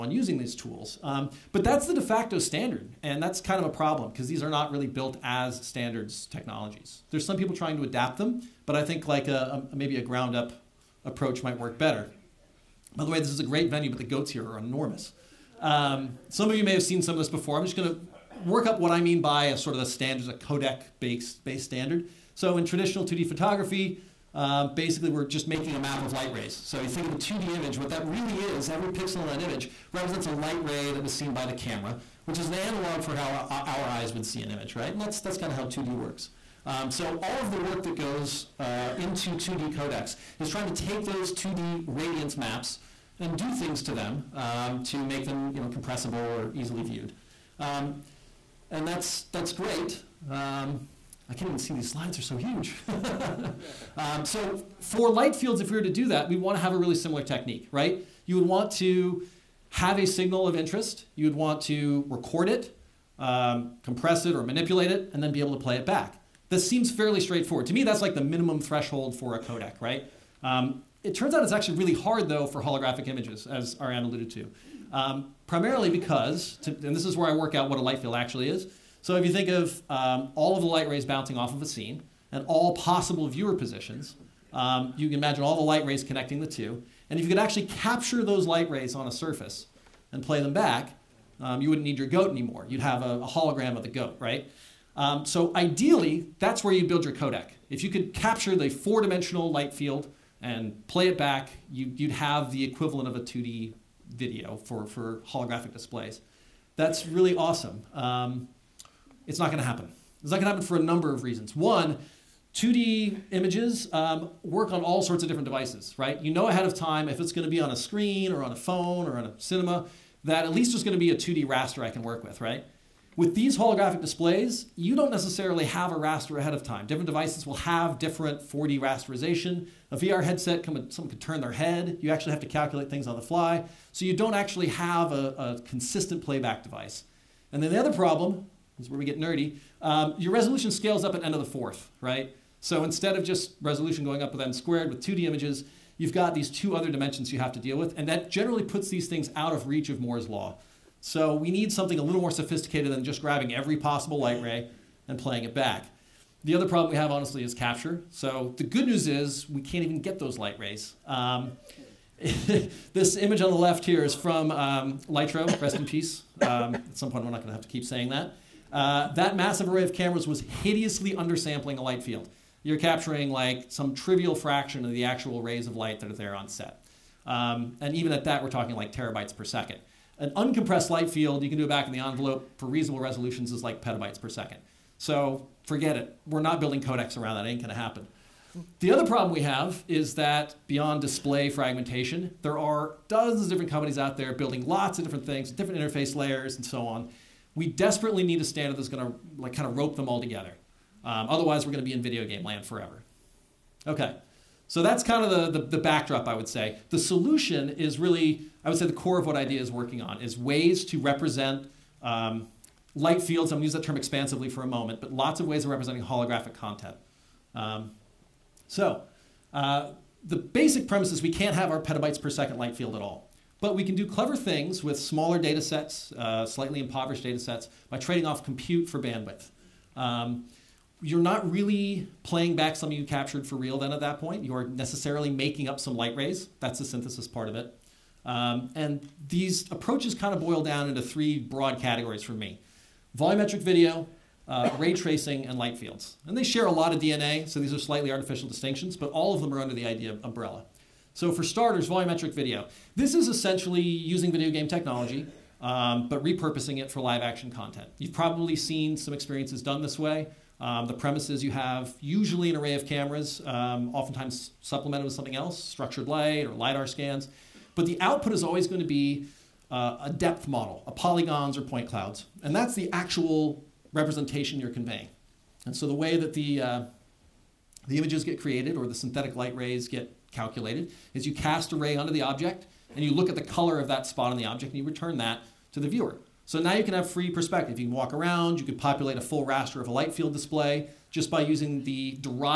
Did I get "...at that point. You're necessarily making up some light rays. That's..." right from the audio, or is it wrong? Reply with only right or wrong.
right.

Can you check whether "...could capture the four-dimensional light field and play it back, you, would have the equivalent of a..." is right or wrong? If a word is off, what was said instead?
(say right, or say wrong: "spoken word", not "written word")
right.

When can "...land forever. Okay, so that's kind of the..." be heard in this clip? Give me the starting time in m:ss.
3:22.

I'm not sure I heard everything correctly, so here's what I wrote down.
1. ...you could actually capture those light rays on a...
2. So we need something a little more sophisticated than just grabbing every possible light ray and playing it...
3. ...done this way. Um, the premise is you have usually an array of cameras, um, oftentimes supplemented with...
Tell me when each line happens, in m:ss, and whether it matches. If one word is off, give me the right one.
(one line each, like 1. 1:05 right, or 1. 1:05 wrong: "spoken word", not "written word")
1. 1:27 right
2. 2:30 right
3. 4:19 right.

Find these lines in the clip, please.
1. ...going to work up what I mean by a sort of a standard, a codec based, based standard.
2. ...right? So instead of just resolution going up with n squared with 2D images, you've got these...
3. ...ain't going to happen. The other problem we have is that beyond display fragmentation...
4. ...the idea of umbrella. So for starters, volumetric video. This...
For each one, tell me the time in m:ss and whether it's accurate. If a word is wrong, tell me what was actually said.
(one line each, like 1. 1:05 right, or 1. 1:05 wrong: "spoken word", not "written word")
1. 0:17 right
2. 2:22 right
3. 3:07 right
4. 4:09 right.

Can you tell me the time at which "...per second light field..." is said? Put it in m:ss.
3:42.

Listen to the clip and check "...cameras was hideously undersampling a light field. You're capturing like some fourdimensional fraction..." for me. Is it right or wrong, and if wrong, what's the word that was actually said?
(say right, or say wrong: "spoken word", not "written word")
wrong: "trivial", not "fourdimensional".